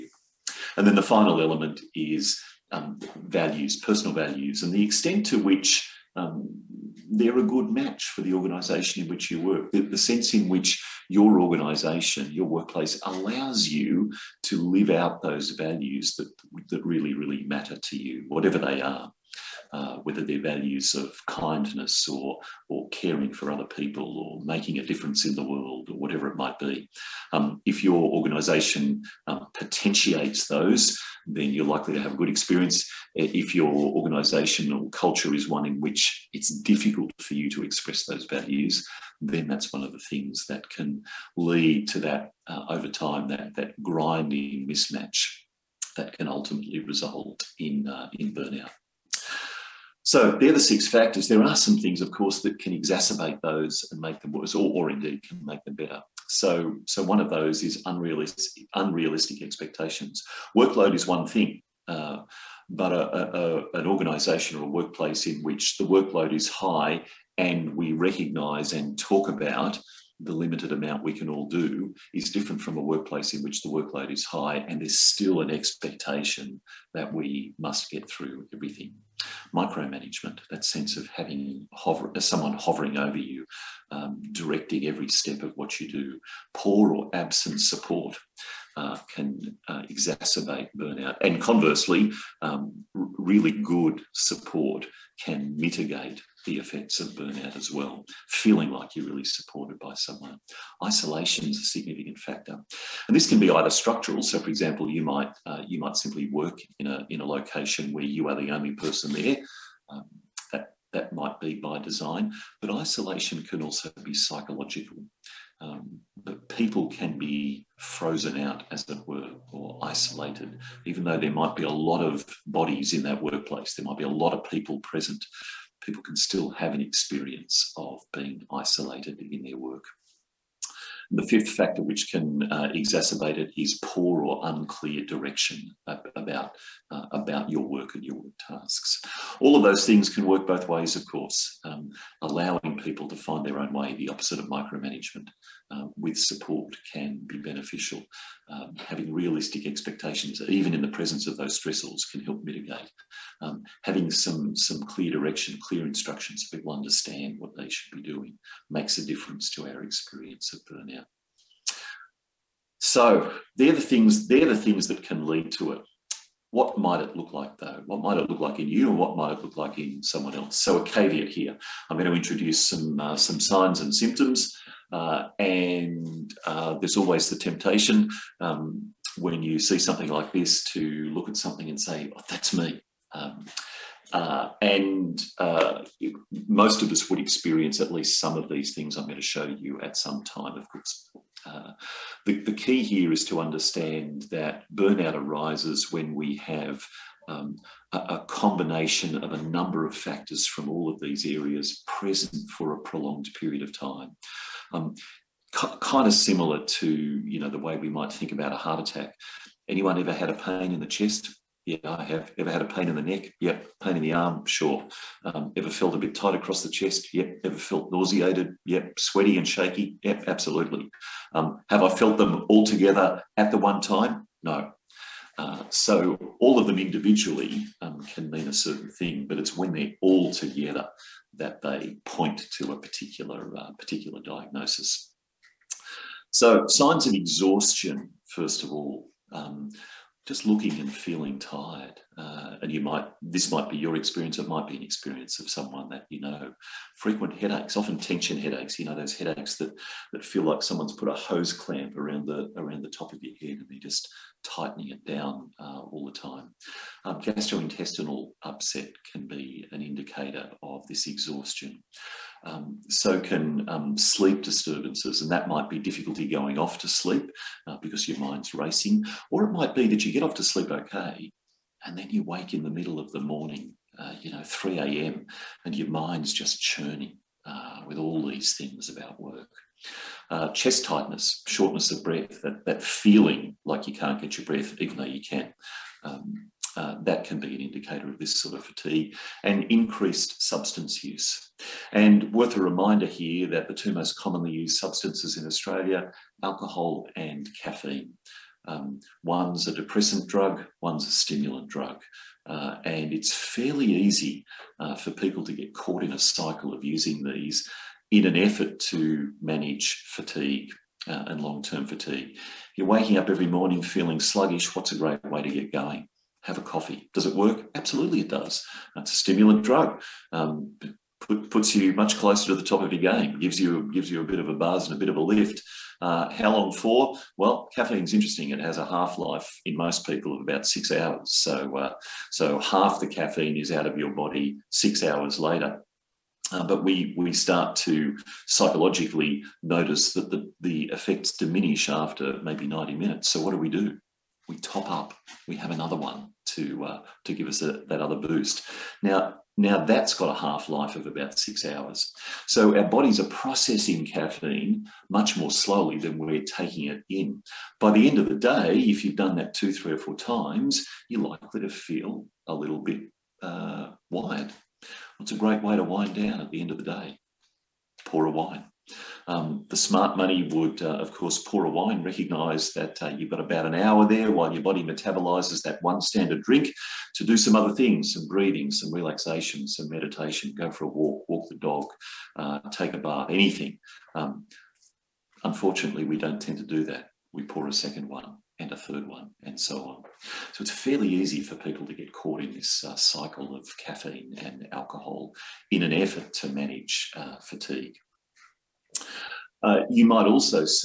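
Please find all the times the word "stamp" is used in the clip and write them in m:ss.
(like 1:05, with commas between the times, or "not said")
not said.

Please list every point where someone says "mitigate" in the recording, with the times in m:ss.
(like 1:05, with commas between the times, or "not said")
1:35, 2:32.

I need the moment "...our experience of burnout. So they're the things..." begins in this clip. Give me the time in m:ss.
2:39.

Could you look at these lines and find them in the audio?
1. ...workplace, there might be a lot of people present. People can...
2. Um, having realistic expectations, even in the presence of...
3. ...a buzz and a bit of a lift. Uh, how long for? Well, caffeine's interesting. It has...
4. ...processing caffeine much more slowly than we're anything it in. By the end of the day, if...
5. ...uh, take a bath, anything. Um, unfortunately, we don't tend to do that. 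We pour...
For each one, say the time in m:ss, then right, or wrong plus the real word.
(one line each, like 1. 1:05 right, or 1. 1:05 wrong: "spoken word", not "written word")
1. 2:03 right
2. 2:28 right
3. 5:24 right
4. 5:53 wrong: "taking", not "anything"
5. 6:22 right.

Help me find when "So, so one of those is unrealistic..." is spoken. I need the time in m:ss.
0:56.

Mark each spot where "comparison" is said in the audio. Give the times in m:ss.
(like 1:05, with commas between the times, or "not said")
not said.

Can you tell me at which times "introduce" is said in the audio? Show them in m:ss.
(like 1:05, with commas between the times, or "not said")
2:52.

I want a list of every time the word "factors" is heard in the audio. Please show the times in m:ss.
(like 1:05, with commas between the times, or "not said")
0:50, 1:42, 2:11, 3:19.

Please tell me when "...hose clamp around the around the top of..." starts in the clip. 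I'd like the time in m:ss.
4:11.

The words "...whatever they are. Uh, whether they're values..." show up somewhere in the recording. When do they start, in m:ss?
0:18.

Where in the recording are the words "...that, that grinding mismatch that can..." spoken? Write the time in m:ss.
0:43.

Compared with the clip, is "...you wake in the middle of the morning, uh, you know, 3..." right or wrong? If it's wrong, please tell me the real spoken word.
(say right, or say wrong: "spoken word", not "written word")
right.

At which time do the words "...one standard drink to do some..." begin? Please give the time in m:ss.
6:15.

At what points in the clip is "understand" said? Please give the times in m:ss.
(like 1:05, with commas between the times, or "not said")
2:36, 3:13.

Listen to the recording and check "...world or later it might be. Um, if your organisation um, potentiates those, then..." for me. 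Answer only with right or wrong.
wrong.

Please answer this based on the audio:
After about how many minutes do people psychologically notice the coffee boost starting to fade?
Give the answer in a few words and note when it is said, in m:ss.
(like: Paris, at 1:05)
90, at 5:42.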